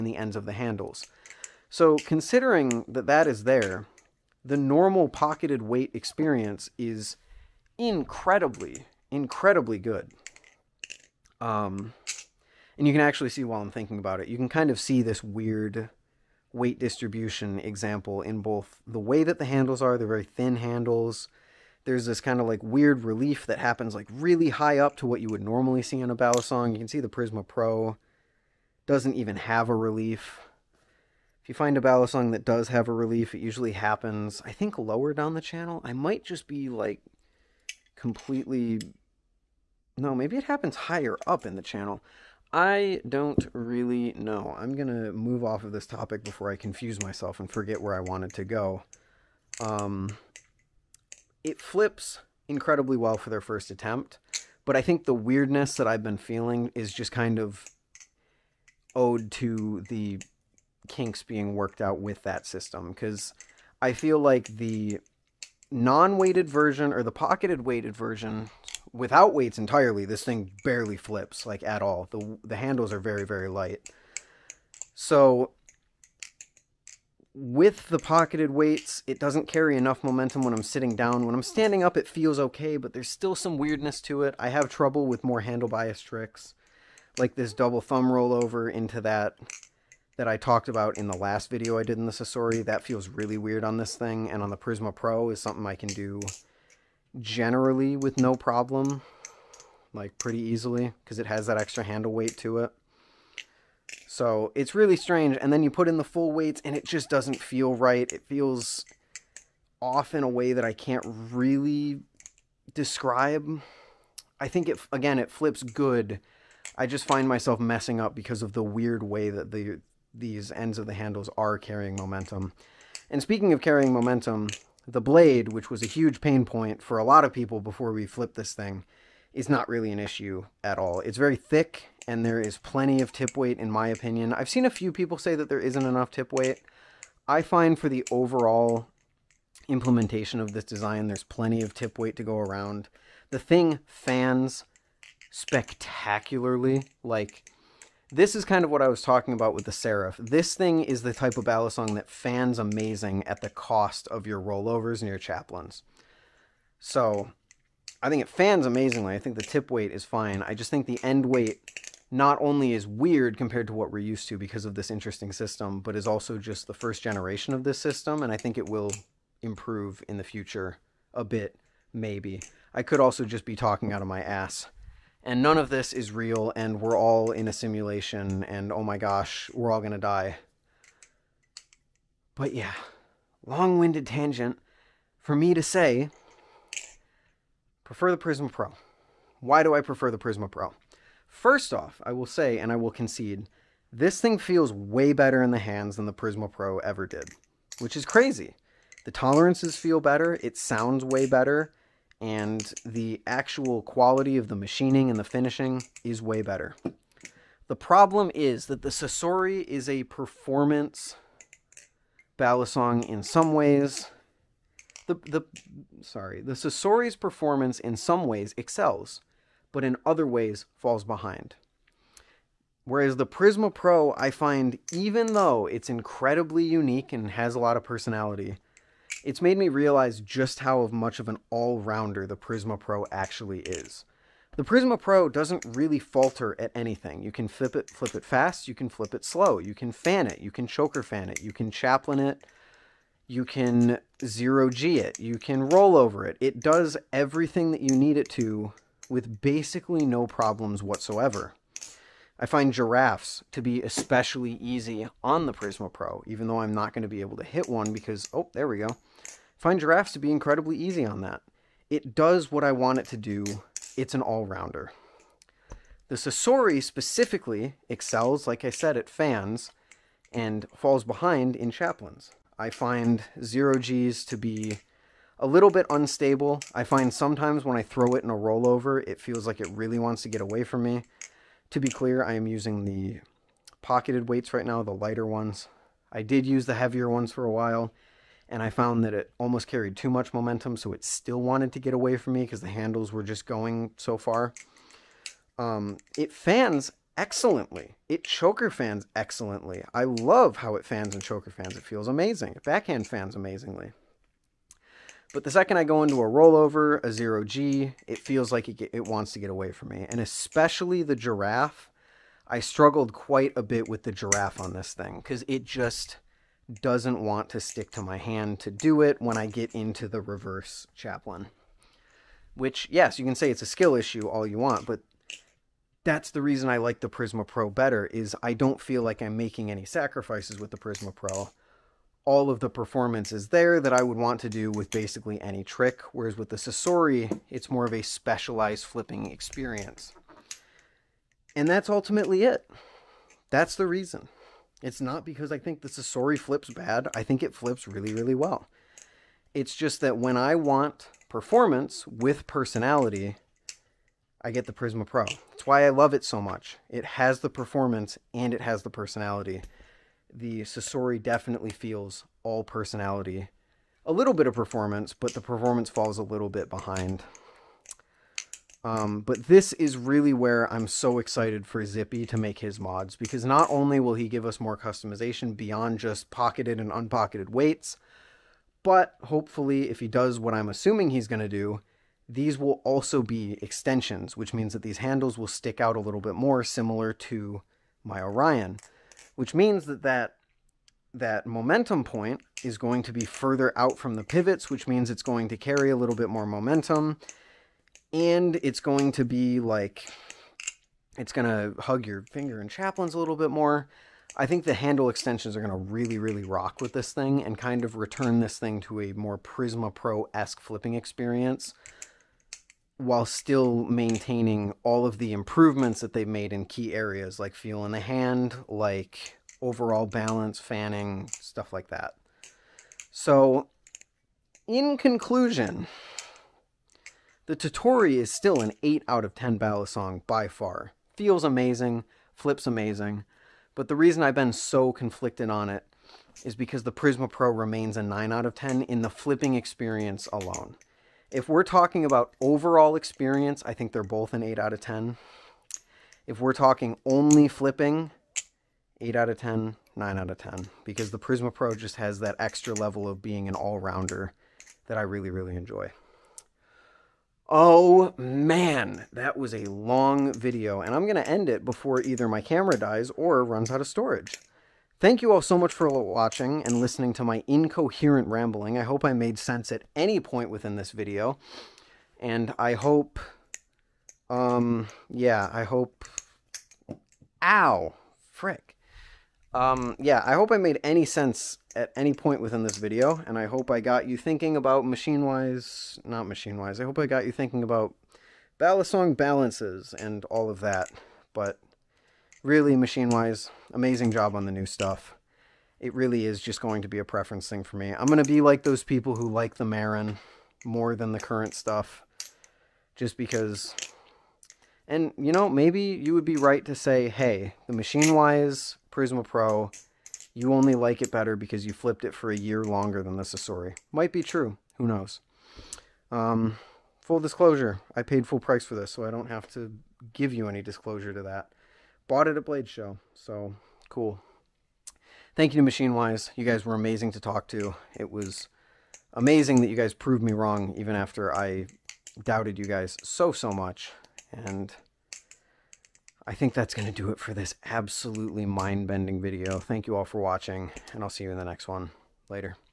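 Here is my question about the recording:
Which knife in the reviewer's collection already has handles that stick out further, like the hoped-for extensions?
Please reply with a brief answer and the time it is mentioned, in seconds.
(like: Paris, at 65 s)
Orion, at 388 s.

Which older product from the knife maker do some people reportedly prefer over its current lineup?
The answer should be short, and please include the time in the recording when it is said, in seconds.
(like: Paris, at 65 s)
Marin, at 499 s.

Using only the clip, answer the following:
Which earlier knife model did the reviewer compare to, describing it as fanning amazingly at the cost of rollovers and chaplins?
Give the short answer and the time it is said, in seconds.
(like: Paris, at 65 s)
Serif, at 149 s.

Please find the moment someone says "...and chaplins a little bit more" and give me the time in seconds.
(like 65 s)
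402 s.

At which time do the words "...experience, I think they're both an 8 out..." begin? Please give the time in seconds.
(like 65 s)
442 s.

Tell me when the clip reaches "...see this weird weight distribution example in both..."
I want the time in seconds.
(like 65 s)
14 s.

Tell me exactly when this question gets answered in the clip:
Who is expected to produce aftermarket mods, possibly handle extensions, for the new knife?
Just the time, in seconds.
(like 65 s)
371 s.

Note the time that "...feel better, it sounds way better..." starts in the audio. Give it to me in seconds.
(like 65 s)
199 s.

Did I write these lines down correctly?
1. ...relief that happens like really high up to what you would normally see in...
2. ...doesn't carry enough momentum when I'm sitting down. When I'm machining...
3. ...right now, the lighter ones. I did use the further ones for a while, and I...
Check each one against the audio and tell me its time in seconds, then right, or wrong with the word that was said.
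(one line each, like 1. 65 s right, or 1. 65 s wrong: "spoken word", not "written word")
1. 23 s right
2. 79 s wrong: "standing", not "machining"
3. 284 s wrong: "heavier", not "further".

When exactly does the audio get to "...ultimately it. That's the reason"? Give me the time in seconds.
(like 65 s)
341 s.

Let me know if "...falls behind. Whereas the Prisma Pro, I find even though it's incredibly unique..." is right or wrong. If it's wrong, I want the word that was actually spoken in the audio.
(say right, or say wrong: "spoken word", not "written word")
right.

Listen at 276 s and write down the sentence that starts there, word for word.
I find sometimes when I throw it in a rollover, it feels like it really wants to get away from me.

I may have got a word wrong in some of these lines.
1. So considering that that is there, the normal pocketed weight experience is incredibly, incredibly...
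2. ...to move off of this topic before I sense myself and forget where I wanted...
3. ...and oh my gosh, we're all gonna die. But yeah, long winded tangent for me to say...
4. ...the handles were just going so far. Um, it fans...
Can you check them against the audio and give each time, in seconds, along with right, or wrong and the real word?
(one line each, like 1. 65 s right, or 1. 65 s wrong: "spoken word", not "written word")
1. 1 s right
2. 44 s wrong: "confuse", not "sense"
3. 178 s right
4. 292 s right.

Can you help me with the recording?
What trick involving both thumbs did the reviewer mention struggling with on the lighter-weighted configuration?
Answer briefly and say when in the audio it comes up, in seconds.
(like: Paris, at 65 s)
double thumb rollover, at 87 s.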